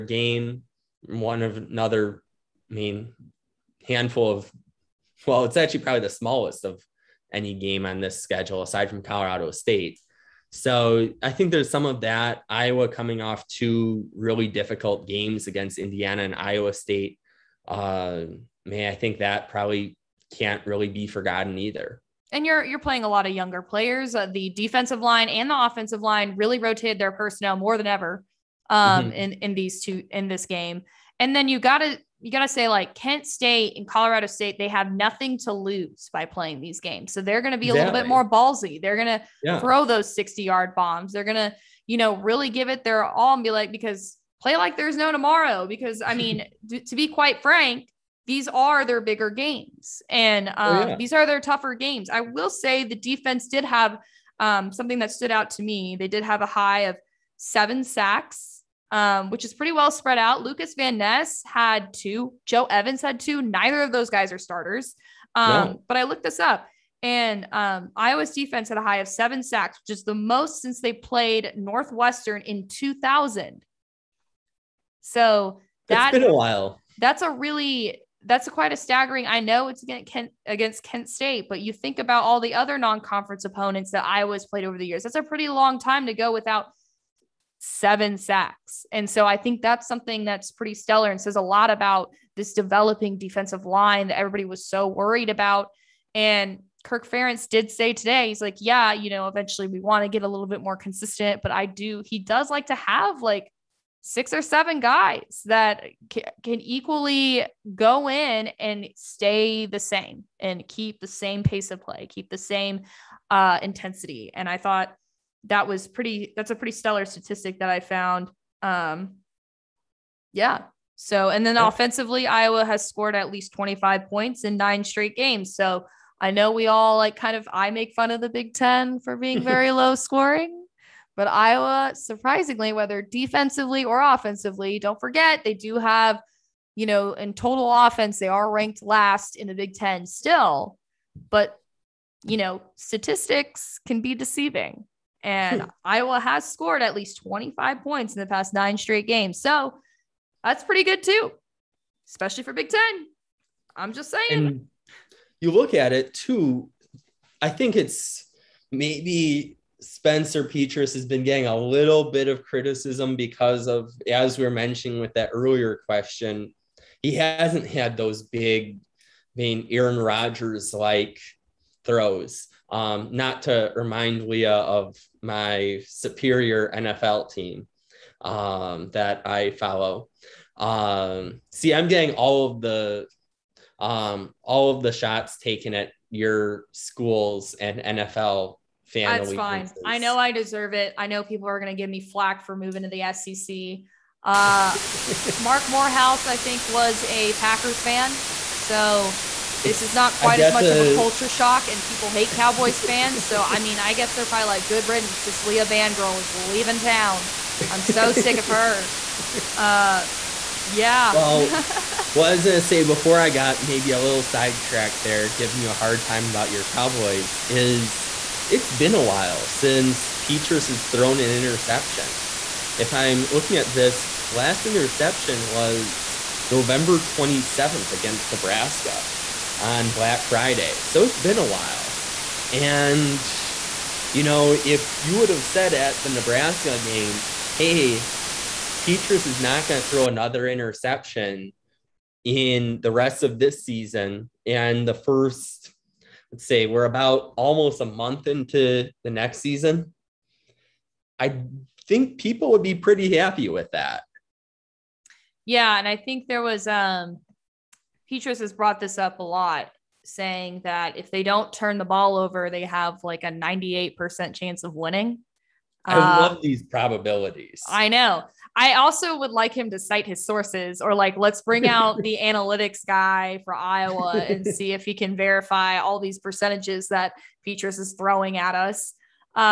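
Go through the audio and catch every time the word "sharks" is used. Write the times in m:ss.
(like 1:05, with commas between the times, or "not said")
not said.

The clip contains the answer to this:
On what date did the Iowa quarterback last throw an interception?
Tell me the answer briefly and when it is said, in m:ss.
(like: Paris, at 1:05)
November 27th, at 3:46.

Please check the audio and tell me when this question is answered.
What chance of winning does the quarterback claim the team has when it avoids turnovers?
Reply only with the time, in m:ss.
4:23.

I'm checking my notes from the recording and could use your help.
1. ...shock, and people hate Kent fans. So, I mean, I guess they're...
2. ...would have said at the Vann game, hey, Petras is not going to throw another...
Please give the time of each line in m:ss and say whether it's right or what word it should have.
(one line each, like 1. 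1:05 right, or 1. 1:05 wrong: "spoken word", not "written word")
1. 3:21 wrong: "Cowboys", not "Kent"
2. 3:55 wrong: "Nebraska", not "Vann".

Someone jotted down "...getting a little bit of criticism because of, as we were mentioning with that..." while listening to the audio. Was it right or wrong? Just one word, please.
right.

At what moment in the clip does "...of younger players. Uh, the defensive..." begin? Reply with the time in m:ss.
0:23.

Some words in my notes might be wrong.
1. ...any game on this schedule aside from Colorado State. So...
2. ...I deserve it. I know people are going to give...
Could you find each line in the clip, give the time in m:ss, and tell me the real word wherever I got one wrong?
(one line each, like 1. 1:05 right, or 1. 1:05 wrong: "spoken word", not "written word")
1. 0:07 right
2. 3:10 right.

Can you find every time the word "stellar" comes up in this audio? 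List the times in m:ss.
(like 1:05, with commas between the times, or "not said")
1:30, 1:56.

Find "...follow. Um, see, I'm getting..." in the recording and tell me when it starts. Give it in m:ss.
2:59.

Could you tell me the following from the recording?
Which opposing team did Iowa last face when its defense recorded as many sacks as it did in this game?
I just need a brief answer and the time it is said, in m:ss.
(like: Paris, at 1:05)
Northwestern, at 1:11.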